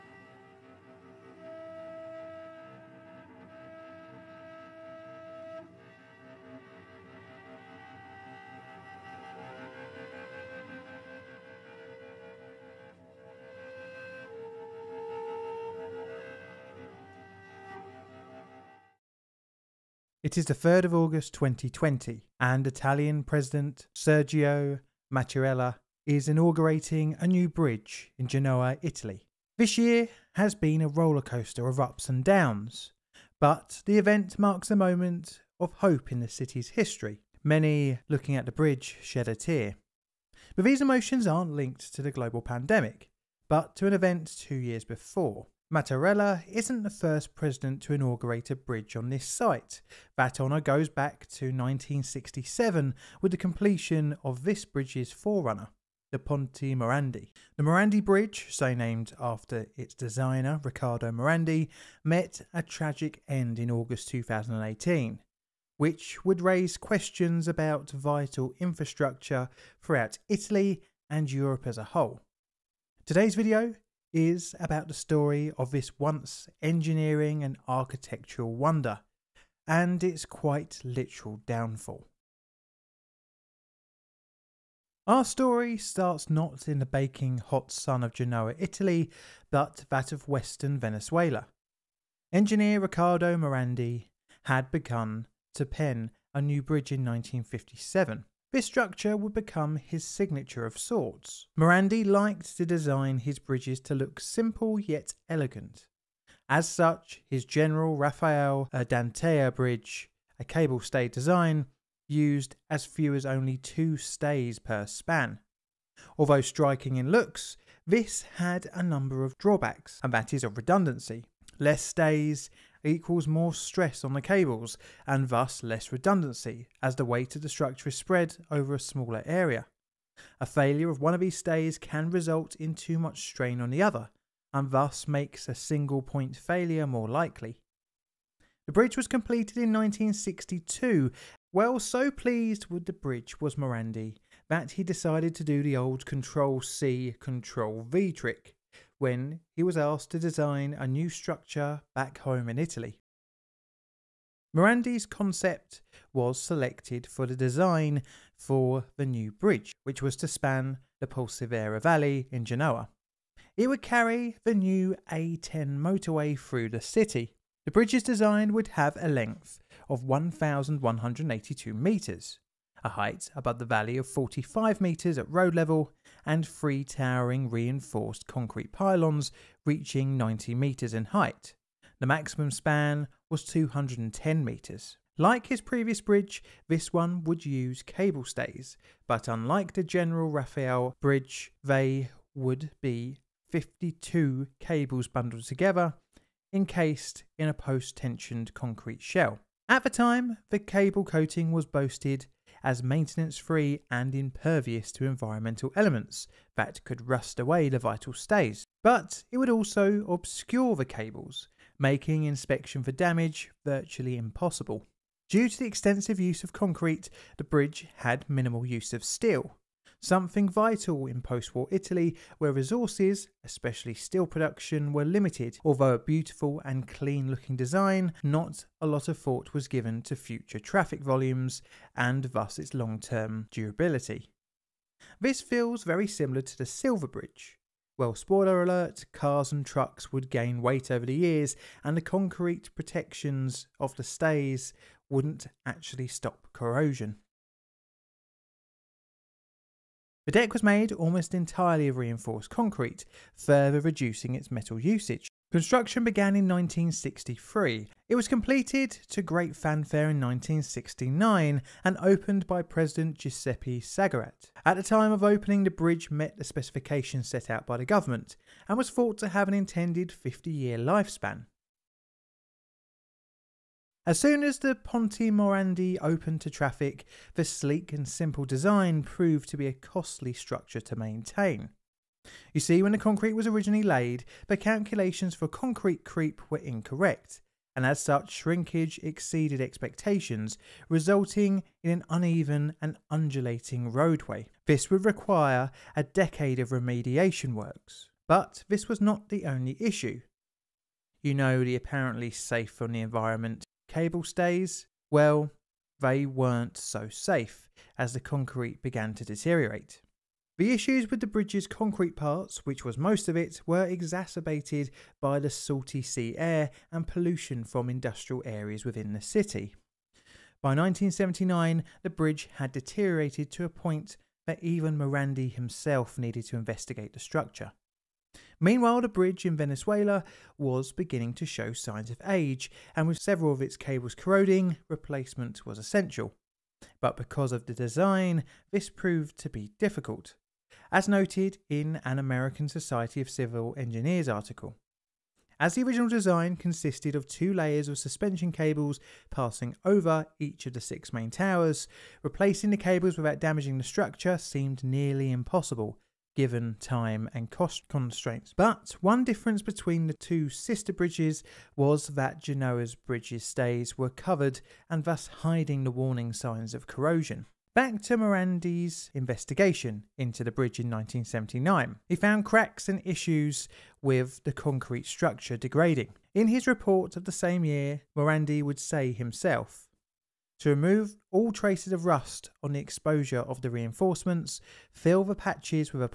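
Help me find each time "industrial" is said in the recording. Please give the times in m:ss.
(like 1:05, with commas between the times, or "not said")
5:17.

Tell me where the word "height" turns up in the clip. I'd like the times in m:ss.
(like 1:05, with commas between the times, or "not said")
2:52, 3:01.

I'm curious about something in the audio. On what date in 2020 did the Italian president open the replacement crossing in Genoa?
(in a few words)
3rd of August.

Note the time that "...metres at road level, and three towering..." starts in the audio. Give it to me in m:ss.
2:54.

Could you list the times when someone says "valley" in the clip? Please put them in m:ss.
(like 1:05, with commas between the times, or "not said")
2:41, 2:53.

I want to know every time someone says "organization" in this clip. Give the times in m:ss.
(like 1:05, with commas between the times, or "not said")
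not said.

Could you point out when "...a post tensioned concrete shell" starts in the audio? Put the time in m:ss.
3:17.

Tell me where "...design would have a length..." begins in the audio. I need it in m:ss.
2:48.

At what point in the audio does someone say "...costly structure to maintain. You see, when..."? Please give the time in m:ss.
4:39.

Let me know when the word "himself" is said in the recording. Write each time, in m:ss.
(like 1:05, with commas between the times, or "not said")
5:25, 6:19.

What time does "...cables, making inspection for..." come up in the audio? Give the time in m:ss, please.
3:30.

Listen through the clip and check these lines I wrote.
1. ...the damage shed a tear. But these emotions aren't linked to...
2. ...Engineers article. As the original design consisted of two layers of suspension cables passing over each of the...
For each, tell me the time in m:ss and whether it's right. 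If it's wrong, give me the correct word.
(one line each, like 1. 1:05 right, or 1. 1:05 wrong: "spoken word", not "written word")
1. 0:38 wrong: "bridge", not "damage"
2. 5:43 right.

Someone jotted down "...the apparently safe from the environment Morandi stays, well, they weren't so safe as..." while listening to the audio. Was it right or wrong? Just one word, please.
wrong.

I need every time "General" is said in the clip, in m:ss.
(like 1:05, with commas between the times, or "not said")
1:47, 3:09.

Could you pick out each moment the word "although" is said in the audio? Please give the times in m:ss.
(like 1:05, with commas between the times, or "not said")
1:56, 3:45.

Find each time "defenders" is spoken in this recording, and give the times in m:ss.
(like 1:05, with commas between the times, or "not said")
not said.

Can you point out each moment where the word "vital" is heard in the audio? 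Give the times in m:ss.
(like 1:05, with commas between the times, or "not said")
1:07, 3:27, 3:40.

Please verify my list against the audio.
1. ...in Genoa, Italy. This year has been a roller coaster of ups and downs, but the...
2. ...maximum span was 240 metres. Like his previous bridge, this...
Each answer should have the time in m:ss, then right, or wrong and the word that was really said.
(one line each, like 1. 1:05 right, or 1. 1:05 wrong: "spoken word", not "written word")
1. 0:28 right
2. 3:02 wrong: "210", not "240".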